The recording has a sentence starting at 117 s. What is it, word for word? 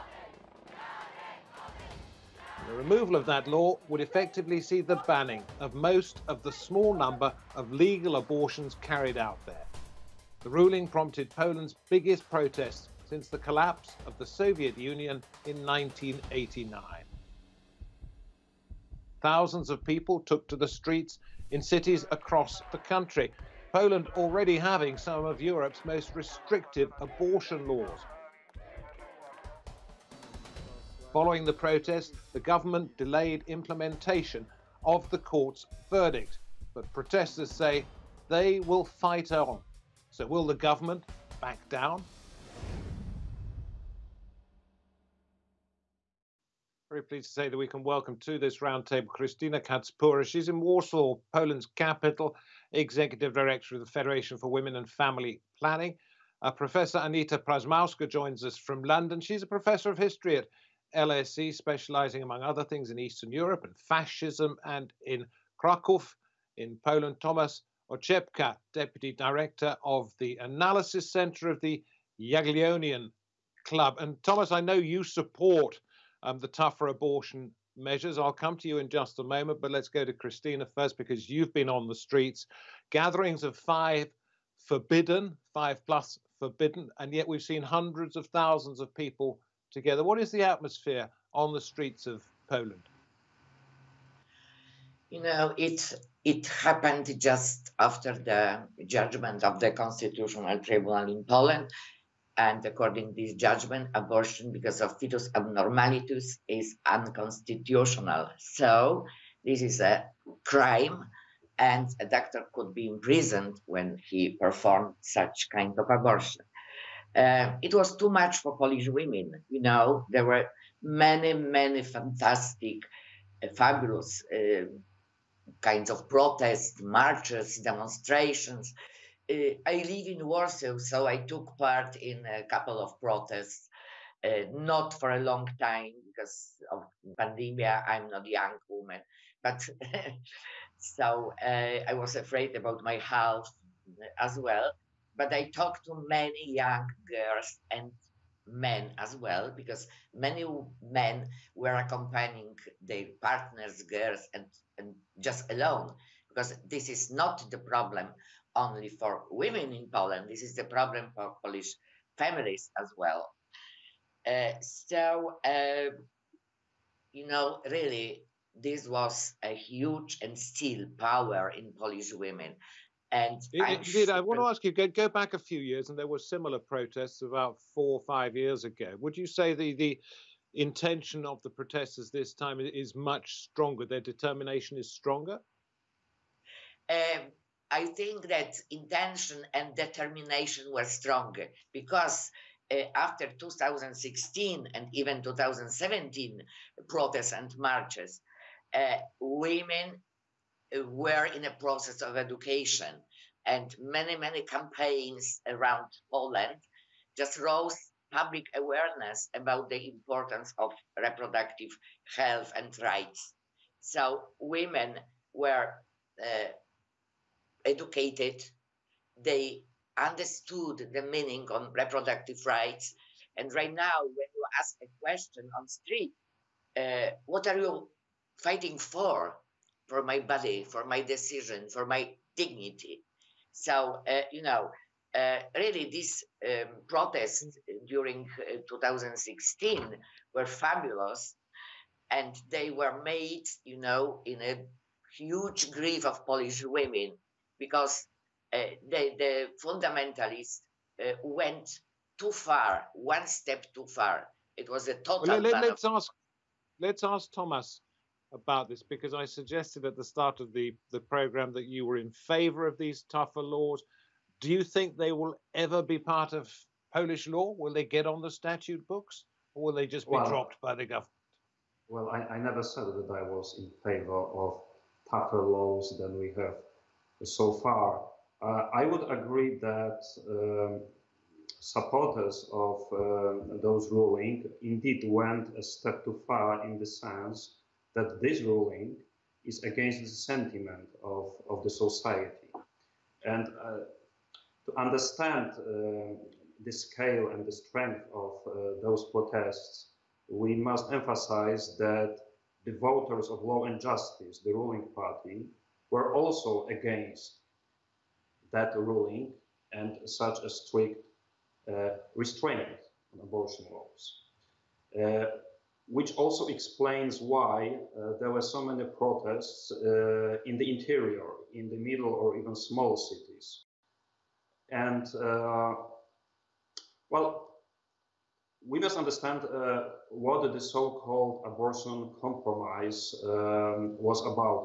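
Uh, it was too much for Polish women.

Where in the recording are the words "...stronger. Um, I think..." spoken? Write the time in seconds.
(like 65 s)
184 s.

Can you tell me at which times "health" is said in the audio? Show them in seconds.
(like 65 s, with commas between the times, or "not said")
142 s, 212 s.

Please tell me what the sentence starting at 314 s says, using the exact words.
Uh, which also explains why uh, there were so many protests uh, in the interior, in the middle, or even small cities.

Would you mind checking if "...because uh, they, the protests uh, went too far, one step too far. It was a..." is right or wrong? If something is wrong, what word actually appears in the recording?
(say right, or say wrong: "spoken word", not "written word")
wrong: "fundamentalists", not "protests".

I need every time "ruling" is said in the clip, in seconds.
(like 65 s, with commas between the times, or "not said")
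10 s, 283 s, 288 s, 304 s, 308 s.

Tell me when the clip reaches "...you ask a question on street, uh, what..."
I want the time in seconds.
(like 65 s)
224 s.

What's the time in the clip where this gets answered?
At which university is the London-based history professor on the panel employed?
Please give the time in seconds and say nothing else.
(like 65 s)
60 s.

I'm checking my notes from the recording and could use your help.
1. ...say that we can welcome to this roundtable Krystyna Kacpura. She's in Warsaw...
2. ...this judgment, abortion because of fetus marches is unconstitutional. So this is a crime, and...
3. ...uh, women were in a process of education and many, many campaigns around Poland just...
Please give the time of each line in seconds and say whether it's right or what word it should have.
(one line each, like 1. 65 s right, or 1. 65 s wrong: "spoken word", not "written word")
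1. 47 s right
2. 103 s wrong: "abnormalities", not "marches"
3. 198 s right.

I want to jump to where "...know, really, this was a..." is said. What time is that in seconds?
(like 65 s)
167 s.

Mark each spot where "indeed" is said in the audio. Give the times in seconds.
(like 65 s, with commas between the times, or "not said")
173 s, 284 s.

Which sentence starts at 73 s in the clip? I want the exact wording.
And Thomas, I know you support um, the tougher abortion measures.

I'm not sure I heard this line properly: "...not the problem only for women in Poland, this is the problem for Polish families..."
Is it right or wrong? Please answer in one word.
right.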